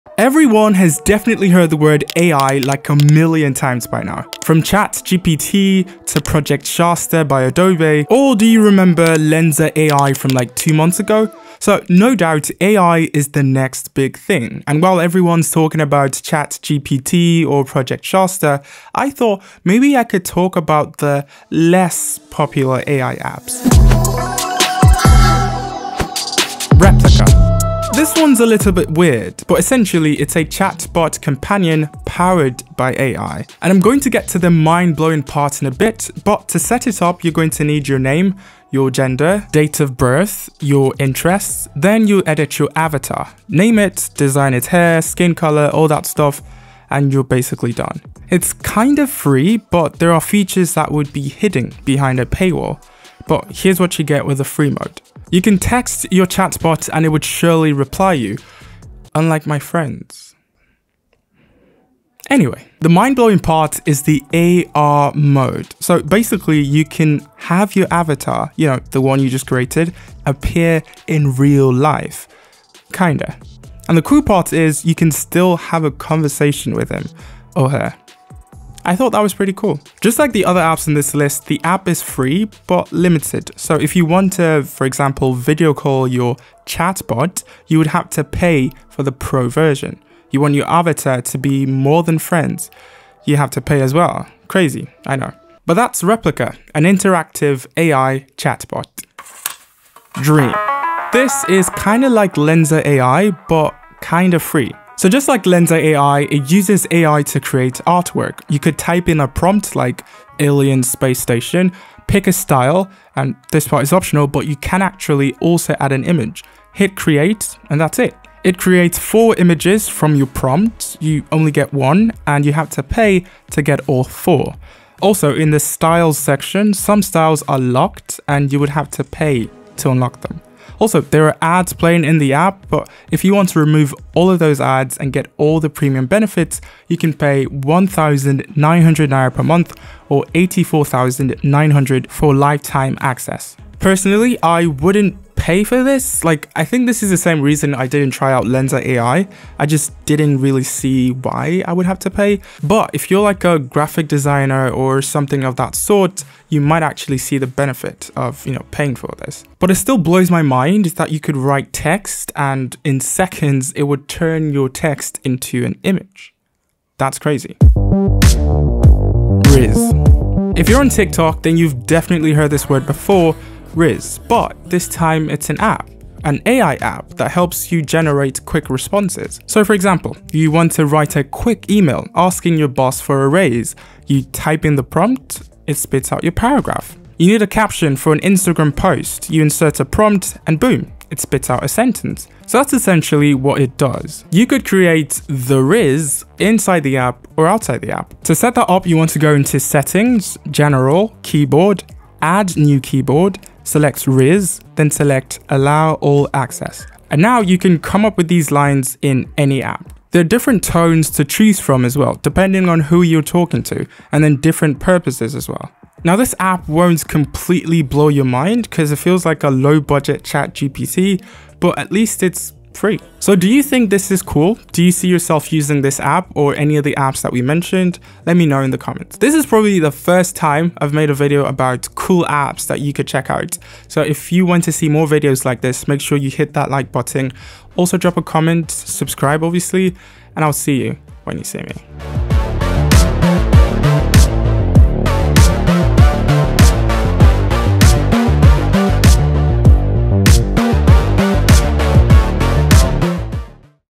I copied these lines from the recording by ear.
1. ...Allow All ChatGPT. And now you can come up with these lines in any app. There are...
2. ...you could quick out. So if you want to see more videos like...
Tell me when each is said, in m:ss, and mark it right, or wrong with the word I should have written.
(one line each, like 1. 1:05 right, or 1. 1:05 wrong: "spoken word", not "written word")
1. 3:25 wrong: "Access", not "ChatGPT"
2. 3:52 wrong: "check", not "quick".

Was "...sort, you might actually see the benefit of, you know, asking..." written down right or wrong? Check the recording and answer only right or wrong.
wrong.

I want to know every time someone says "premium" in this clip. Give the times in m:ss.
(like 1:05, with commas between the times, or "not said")
2:15.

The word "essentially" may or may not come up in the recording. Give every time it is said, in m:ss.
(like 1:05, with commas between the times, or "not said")
0:29, 3:12.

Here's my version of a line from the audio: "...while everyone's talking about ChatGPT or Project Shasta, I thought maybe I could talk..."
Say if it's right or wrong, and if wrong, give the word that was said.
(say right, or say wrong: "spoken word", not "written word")
right.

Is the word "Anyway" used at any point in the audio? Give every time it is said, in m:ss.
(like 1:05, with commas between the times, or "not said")
1:02.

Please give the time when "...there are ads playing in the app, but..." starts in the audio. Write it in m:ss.
2:10.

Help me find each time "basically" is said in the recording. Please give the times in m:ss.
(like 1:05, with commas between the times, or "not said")
0:47, 1:06.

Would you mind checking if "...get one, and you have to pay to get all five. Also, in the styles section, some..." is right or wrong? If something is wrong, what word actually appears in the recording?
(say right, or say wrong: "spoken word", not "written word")
wrong: "four", not "five".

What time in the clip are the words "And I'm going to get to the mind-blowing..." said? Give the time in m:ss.
0:33.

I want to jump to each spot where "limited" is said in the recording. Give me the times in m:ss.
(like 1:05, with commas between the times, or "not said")
1:22.